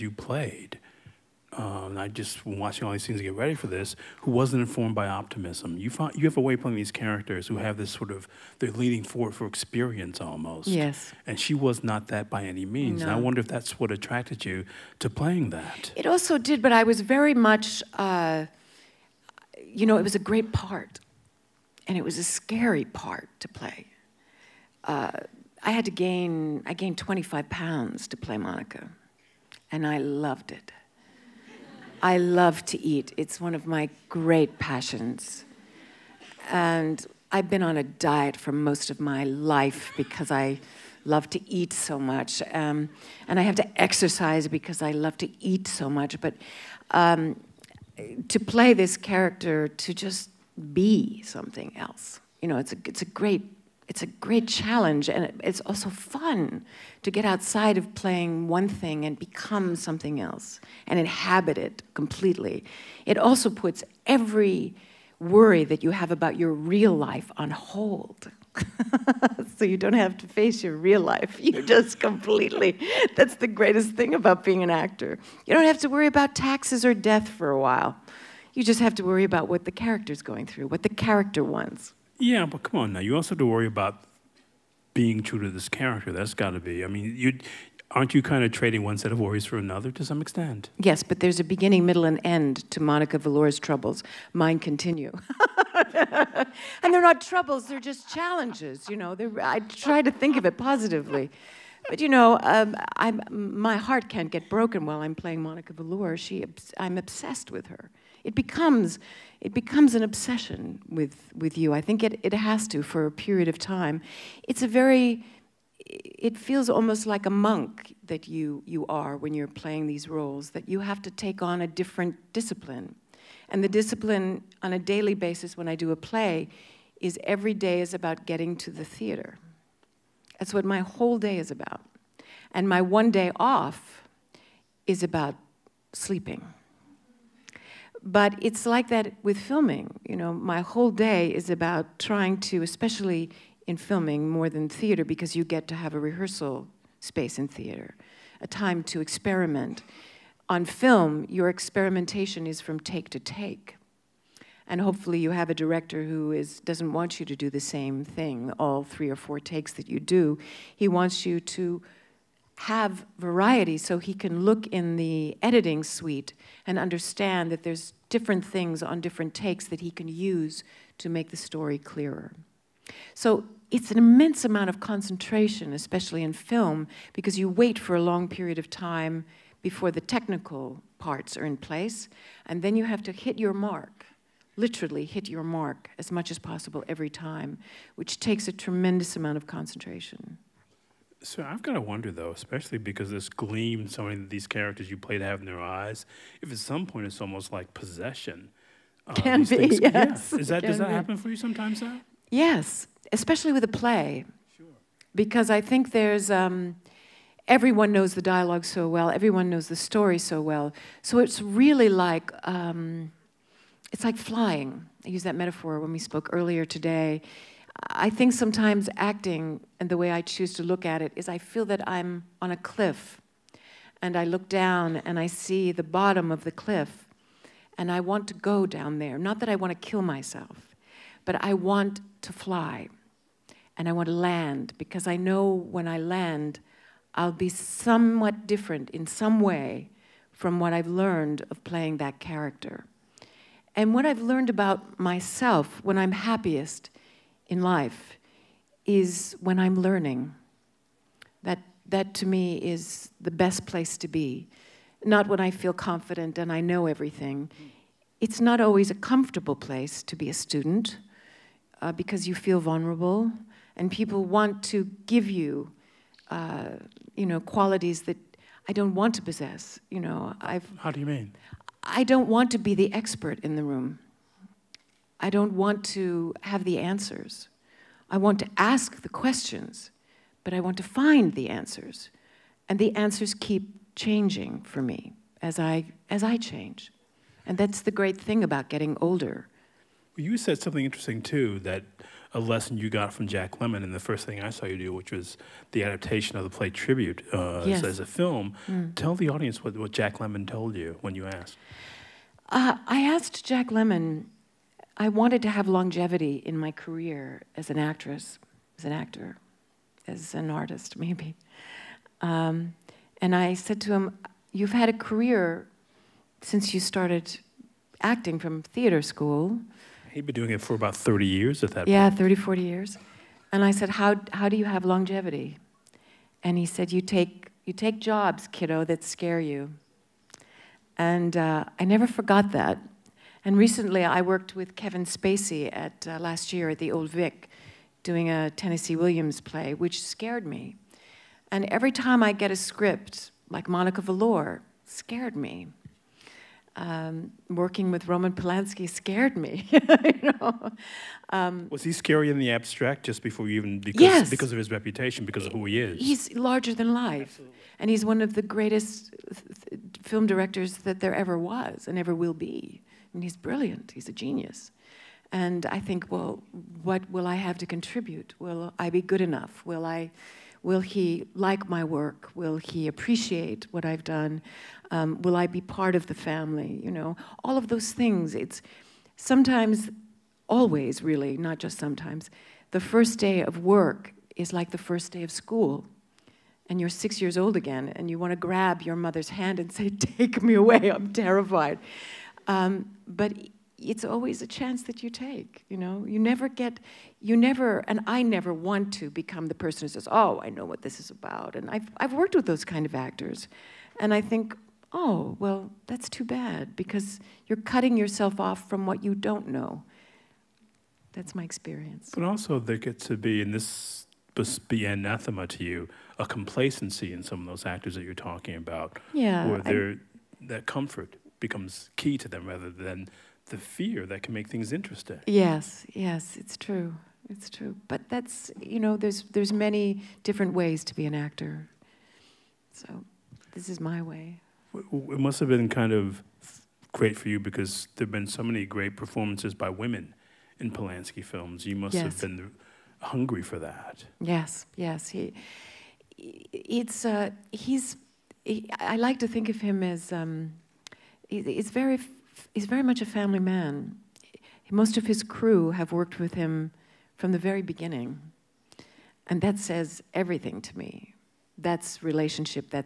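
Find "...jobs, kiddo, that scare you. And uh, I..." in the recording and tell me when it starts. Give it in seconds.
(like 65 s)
328 s.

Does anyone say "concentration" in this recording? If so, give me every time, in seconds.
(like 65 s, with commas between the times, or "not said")
174 s, 189 s.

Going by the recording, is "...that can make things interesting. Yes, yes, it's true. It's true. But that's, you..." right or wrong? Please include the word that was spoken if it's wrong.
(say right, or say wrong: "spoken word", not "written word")
right.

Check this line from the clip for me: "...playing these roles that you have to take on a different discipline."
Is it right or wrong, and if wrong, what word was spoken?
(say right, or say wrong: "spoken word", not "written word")
right.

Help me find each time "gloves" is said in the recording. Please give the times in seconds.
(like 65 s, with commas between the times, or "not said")
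not said.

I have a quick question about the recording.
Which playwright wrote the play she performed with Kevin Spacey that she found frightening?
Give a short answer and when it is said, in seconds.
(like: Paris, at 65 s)
Tennessee Williams, at 338 s.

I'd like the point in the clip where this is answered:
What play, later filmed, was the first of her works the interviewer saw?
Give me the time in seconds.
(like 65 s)
296 s.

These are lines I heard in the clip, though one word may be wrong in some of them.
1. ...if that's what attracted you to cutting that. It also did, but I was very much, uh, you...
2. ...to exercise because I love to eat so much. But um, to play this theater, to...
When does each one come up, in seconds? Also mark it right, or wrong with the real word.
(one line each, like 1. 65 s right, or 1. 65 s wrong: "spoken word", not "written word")
1. 13 s wrong: "playing", not "cutting"
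2. 43 s wrong: "character", not "theater".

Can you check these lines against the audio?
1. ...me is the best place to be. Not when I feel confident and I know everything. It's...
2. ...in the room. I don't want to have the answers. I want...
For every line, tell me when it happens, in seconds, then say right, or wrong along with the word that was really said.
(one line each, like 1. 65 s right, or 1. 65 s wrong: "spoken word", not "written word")
1. 252 s right
2. 273 s right.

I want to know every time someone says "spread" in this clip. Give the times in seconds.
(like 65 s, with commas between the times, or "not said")
not said.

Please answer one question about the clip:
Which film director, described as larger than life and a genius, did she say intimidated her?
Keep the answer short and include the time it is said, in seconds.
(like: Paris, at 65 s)
Roman Polanski, at 348 s.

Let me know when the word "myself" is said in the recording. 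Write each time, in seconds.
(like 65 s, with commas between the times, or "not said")
230 s, 244 s.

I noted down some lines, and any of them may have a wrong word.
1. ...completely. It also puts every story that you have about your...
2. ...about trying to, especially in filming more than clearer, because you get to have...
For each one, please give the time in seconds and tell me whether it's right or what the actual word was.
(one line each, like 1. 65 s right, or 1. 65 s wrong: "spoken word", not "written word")
1. 61 s wrong: "worry", not "story"
2. 141 s wrong: "theater", not "clearer".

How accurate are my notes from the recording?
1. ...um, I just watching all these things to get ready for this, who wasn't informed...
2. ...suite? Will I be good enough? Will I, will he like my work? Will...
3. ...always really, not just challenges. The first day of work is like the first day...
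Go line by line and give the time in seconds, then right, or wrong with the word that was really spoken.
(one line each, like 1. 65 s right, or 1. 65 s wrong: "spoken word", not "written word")
1. 1 s right
2. 367 s wrong: "contribute", not "suite"
3. 380 s wrong: "sometimes", not "challenges".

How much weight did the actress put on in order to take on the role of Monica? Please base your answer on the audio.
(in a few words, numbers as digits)
25 pounds.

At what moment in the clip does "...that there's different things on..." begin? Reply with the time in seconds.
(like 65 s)
167 s.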